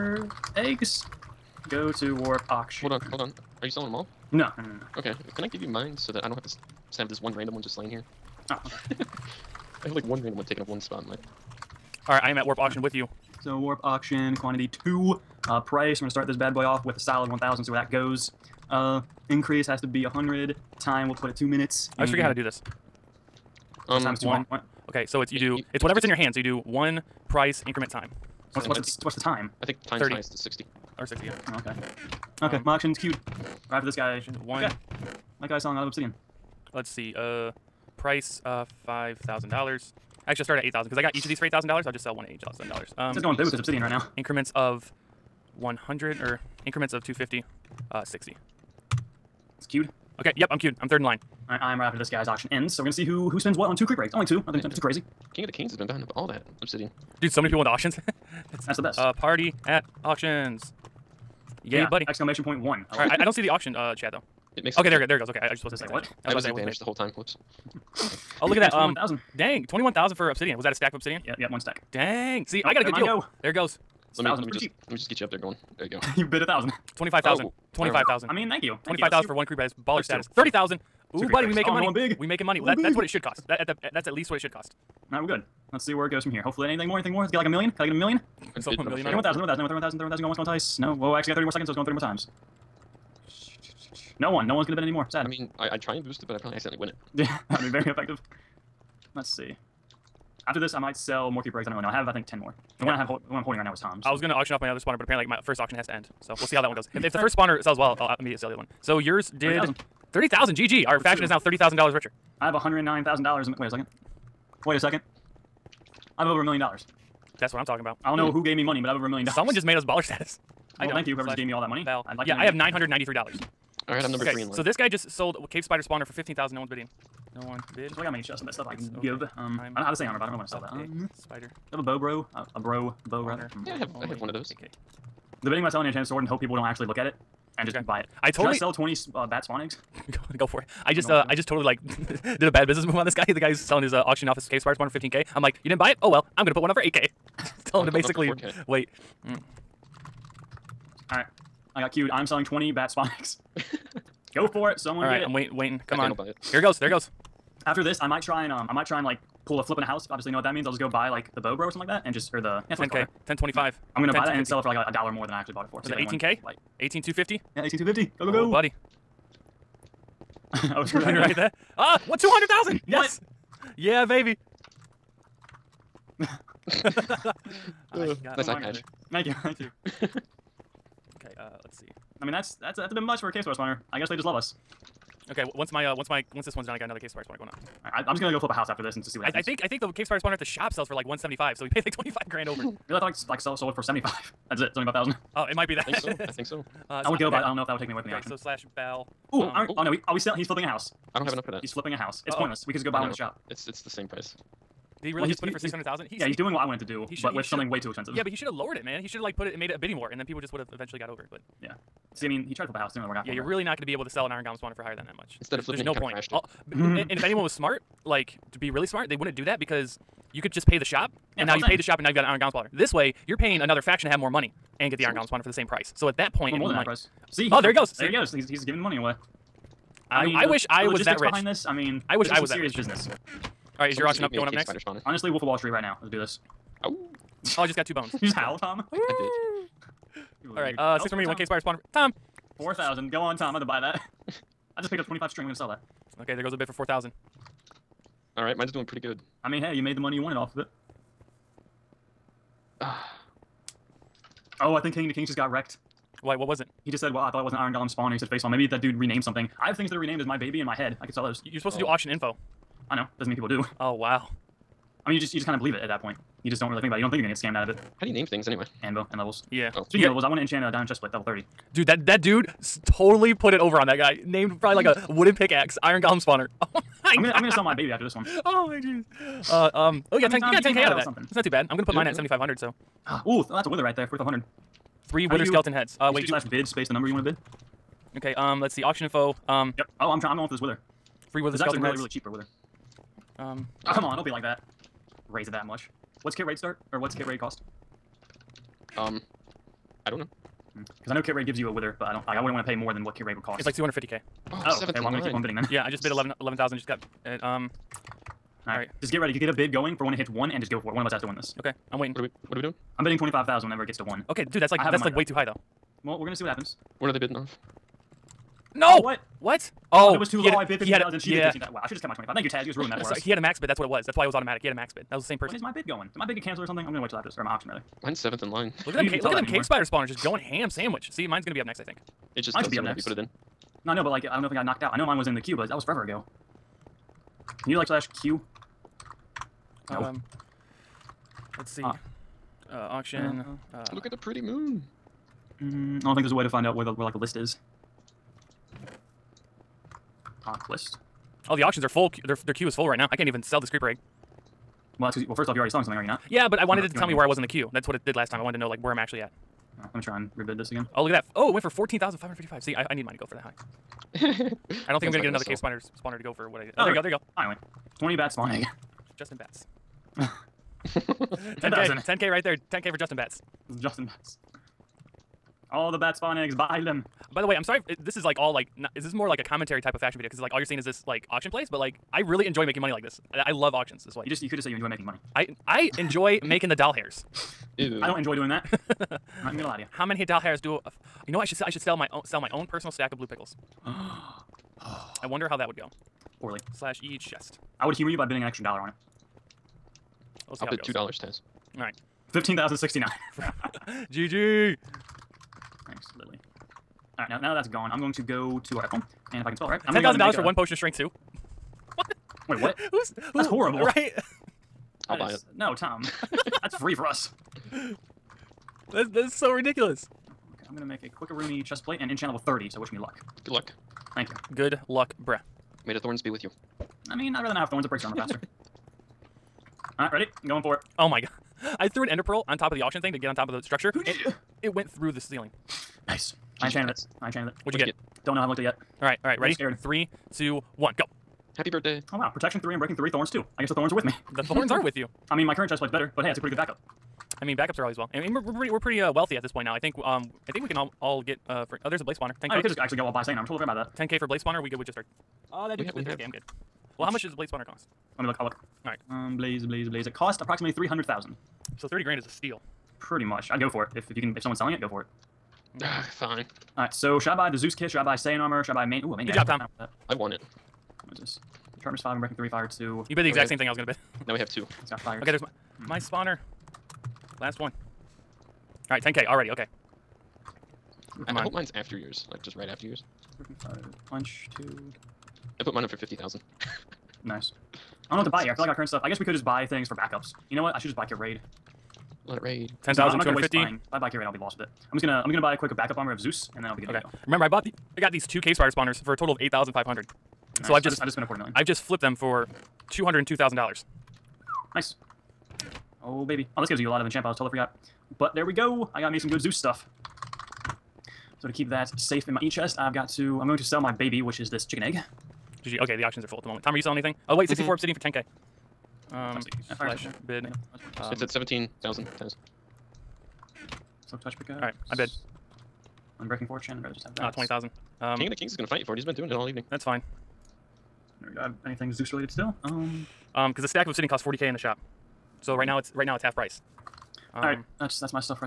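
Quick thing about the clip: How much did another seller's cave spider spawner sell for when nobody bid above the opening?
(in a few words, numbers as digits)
15,000.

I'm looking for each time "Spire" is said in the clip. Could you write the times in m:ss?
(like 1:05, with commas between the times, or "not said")
4:01.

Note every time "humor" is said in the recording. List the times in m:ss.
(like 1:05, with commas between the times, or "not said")
6:37.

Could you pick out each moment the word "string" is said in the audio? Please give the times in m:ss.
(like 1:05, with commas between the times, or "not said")
4:05.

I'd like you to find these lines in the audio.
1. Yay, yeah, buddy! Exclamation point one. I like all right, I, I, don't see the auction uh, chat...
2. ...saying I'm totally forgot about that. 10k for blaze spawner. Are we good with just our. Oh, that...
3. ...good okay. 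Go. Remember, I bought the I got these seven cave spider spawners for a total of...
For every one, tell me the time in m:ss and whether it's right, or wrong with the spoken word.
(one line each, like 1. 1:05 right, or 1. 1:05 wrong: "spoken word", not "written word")
1. 1:01 right
2. 7:33 right
3. 8:16 wrong: "two", not "seven".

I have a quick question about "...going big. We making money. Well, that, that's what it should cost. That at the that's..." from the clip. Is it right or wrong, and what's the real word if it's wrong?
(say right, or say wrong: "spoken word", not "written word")
right.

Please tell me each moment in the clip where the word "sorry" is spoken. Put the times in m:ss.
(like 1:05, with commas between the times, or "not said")
5:23, 6:17.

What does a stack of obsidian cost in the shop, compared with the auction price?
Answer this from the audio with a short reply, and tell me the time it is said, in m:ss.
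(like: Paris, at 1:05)
40k, at 8:54.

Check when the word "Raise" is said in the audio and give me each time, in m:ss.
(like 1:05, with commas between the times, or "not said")
4:55.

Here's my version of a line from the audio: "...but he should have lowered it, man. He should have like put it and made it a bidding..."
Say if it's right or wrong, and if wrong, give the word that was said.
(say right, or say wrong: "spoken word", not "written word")
right.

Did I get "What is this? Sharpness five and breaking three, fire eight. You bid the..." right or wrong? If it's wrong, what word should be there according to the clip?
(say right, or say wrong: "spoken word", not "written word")
wrong: "two", not "eight".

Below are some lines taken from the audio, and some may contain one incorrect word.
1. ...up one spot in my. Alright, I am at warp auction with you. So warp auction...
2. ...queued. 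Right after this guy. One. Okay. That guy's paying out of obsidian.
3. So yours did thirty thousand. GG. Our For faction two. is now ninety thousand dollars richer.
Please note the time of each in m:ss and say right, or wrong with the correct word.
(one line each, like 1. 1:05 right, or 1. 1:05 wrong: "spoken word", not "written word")
1. 0:10 right
2. 0:32 wrong: "selling", not "paying"
3. 1:48 wrong: "thirty", not "ninety".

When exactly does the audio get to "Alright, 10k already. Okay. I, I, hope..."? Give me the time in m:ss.
7:58.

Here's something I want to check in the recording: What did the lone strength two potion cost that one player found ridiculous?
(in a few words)
10,000.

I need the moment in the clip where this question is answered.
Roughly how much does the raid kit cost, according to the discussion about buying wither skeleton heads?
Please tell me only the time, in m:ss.
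5:03.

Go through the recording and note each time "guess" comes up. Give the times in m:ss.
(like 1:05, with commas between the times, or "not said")
3:03, 7:23, 8:09.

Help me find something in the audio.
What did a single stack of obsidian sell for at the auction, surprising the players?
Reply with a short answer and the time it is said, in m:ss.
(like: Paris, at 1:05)
21,000, at 1:09.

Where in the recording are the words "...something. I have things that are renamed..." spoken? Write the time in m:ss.
4:19.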